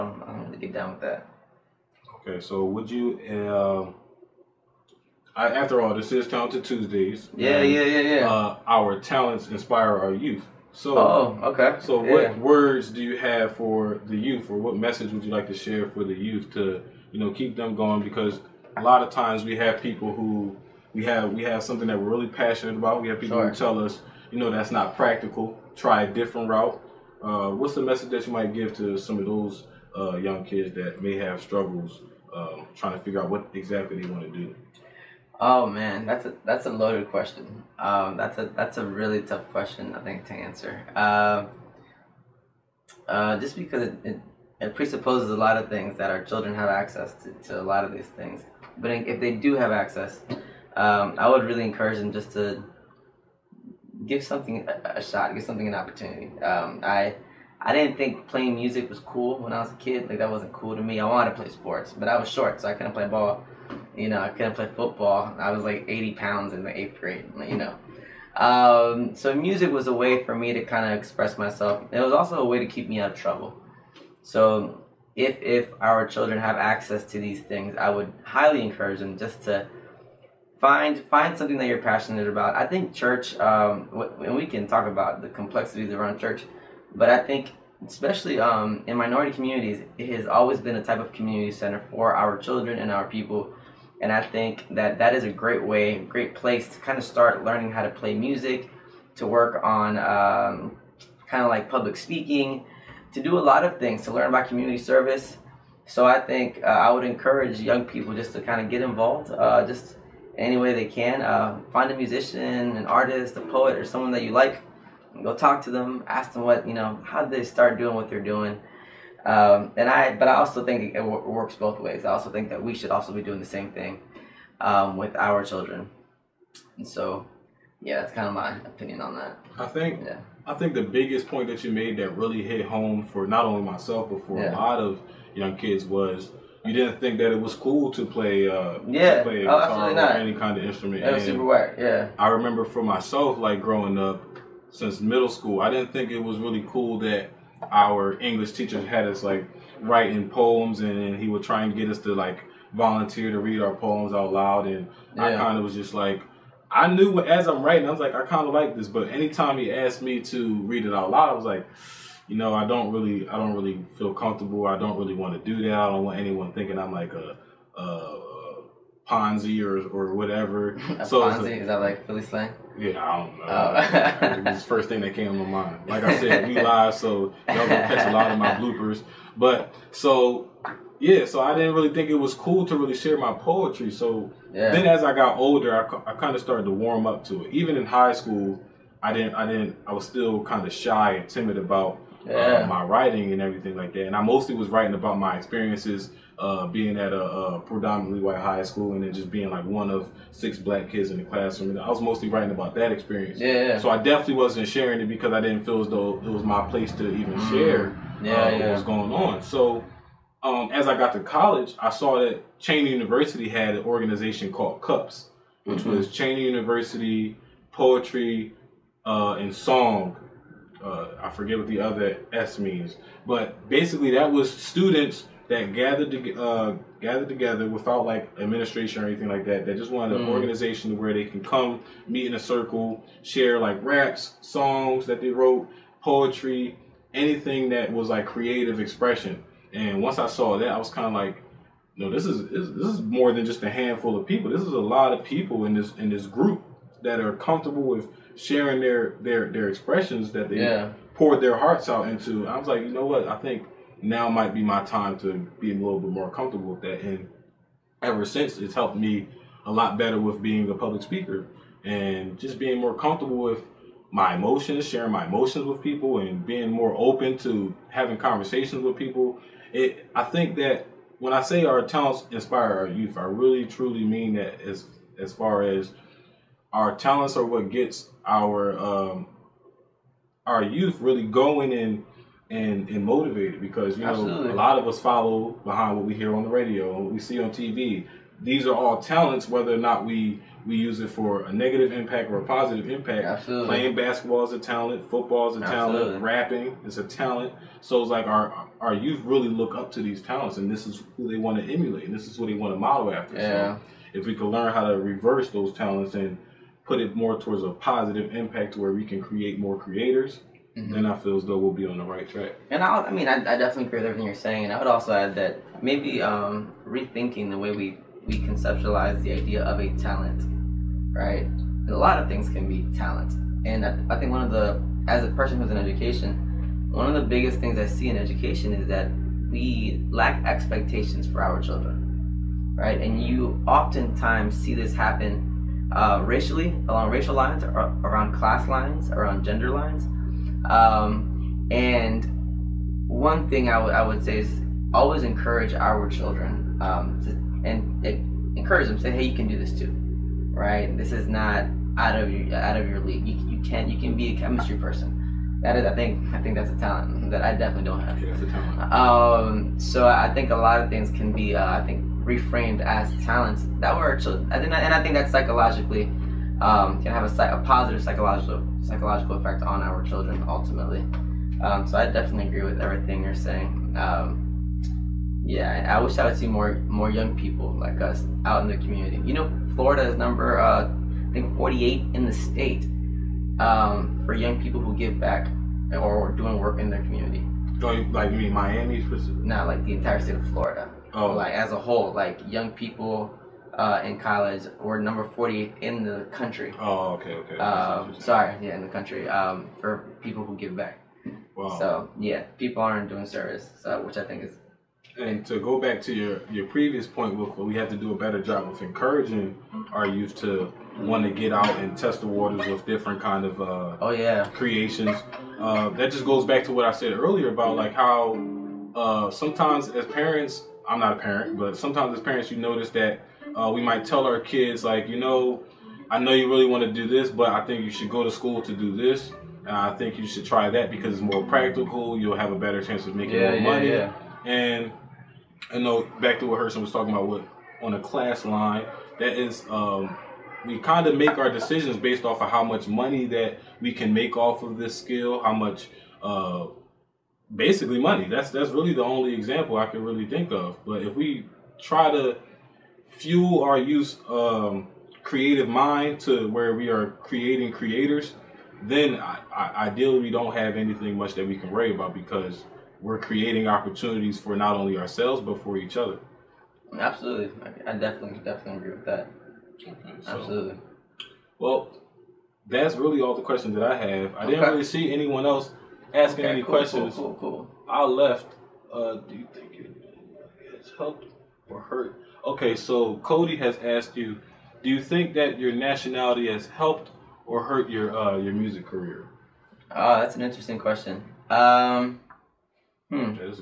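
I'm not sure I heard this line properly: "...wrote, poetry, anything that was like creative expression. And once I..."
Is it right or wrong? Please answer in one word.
right.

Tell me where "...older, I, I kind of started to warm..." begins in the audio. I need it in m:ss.
3:05.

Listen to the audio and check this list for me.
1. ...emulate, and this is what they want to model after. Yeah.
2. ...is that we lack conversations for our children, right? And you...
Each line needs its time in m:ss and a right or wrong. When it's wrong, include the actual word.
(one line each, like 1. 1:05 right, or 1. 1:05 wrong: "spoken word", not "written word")
1. 5:01 right
2. 5:28 wrong: "expectations", not "conversations".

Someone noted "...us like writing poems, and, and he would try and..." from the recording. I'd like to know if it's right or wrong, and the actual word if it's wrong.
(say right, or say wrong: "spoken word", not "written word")
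right.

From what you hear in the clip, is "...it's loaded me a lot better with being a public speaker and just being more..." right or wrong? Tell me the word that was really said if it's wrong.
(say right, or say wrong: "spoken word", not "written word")
wrong: "helped", not "loaded".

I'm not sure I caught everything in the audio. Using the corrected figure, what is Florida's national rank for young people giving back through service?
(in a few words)
40.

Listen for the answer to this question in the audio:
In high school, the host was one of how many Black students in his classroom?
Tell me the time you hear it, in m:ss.
3:20.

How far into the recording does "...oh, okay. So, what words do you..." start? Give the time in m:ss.
0:10.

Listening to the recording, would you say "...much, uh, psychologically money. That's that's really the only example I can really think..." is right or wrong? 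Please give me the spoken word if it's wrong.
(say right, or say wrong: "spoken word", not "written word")
wrong: "basically", not "psychologically".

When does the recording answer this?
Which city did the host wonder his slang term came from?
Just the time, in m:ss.
2:52.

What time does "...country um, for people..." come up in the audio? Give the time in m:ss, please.
6:38.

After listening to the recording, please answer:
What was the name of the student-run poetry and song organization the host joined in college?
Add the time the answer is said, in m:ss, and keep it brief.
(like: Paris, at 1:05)
Cups, at 3:34.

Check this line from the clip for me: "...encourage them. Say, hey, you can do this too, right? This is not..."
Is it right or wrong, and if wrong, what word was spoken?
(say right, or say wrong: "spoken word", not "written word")
right.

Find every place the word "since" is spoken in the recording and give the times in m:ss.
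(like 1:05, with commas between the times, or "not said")
2:24, 4:18.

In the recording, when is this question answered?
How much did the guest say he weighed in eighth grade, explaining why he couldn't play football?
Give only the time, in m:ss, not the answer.
1:05.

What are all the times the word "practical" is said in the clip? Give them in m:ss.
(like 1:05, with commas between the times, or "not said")
0:24, 7:11.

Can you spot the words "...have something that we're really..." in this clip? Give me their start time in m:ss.
0:21.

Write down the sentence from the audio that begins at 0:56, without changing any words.
Um, I I didn't think playing music was cool when I was a kid.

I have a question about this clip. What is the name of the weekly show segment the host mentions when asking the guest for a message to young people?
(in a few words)
Talented Tuesdays.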